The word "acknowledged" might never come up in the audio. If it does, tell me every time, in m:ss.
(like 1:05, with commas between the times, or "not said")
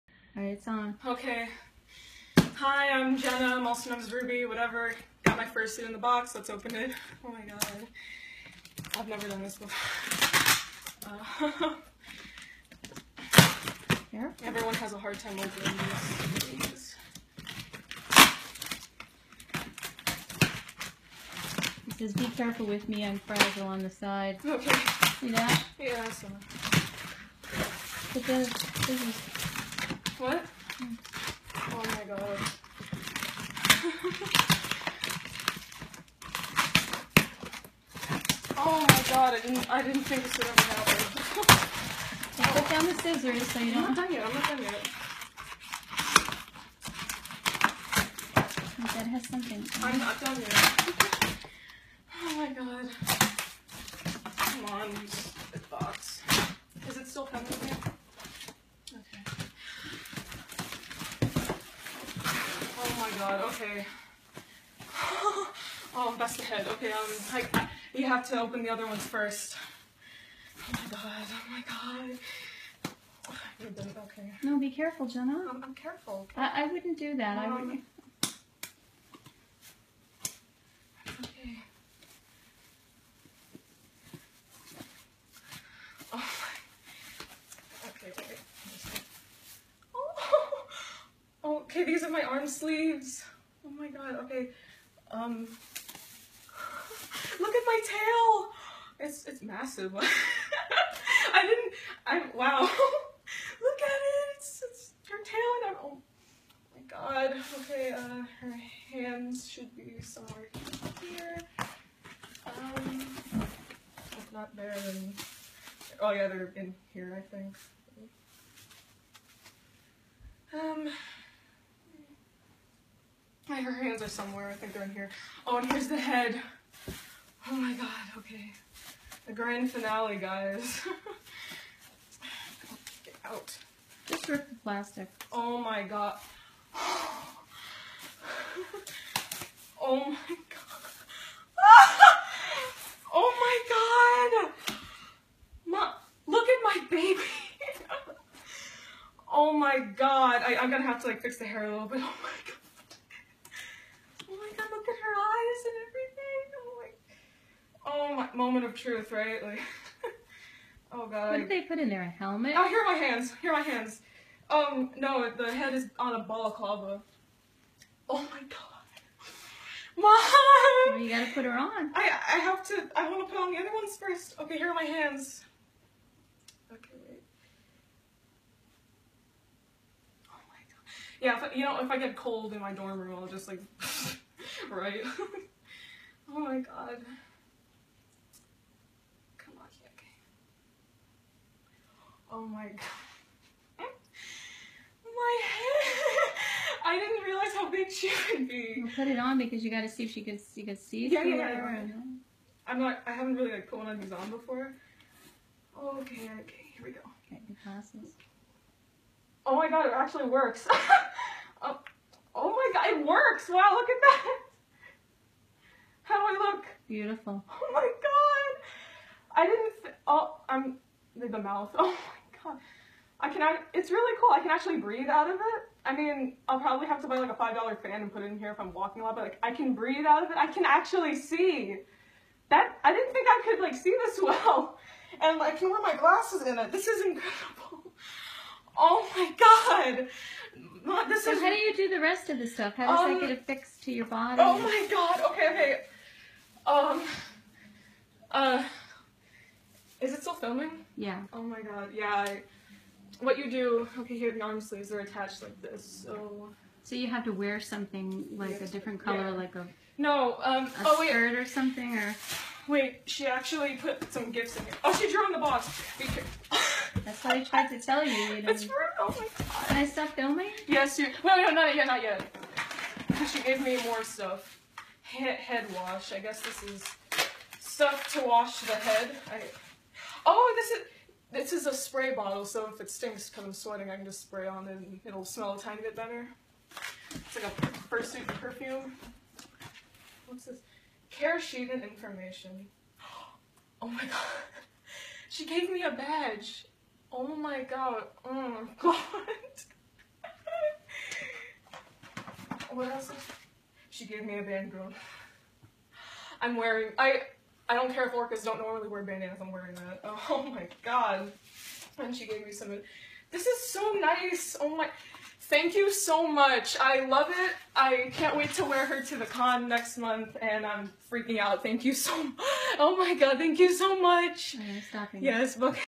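not said.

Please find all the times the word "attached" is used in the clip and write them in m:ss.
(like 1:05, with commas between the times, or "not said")
4:14.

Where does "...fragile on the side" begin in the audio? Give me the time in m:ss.
0:23.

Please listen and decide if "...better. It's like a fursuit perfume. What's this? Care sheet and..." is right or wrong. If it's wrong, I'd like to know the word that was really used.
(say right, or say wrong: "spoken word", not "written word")
right.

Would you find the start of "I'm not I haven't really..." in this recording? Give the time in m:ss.
3:22.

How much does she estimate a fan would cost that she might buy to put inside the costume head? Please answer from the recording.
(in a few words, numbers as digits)
$5.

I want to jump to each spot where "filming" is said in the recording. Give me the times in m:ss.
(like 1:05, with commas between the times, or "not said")
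4:10, 4:30.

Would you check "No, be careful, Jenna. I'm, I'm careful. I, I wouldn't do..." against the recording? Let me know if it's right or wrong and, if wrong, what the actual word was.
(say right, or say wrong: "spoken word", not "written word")
right.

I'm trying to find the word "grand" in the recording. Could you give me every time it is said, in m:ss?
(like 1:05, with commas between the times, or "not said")
2:09.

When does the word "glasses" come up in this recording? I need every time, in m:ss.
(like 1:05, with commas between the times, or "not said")
3:27, 3:55.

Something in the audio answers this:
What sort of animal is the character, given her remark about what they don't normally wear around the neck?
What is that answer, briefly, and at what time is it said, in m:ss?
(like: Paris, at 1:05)
orcas, at 5:08.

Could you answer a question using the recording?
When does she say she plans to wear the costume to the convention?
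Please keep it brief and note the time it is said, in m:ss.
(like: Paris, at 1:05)
next month, at 5:19.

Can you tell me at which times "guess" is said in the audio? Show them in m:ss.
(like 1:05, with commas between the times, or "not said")
4:36.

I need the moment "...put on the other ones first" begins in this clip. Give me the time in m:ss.
2:53.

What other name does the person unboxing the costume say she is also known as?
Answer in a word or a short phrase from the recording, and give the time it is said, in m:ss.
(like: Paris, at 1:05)
Ruby, at 0:04.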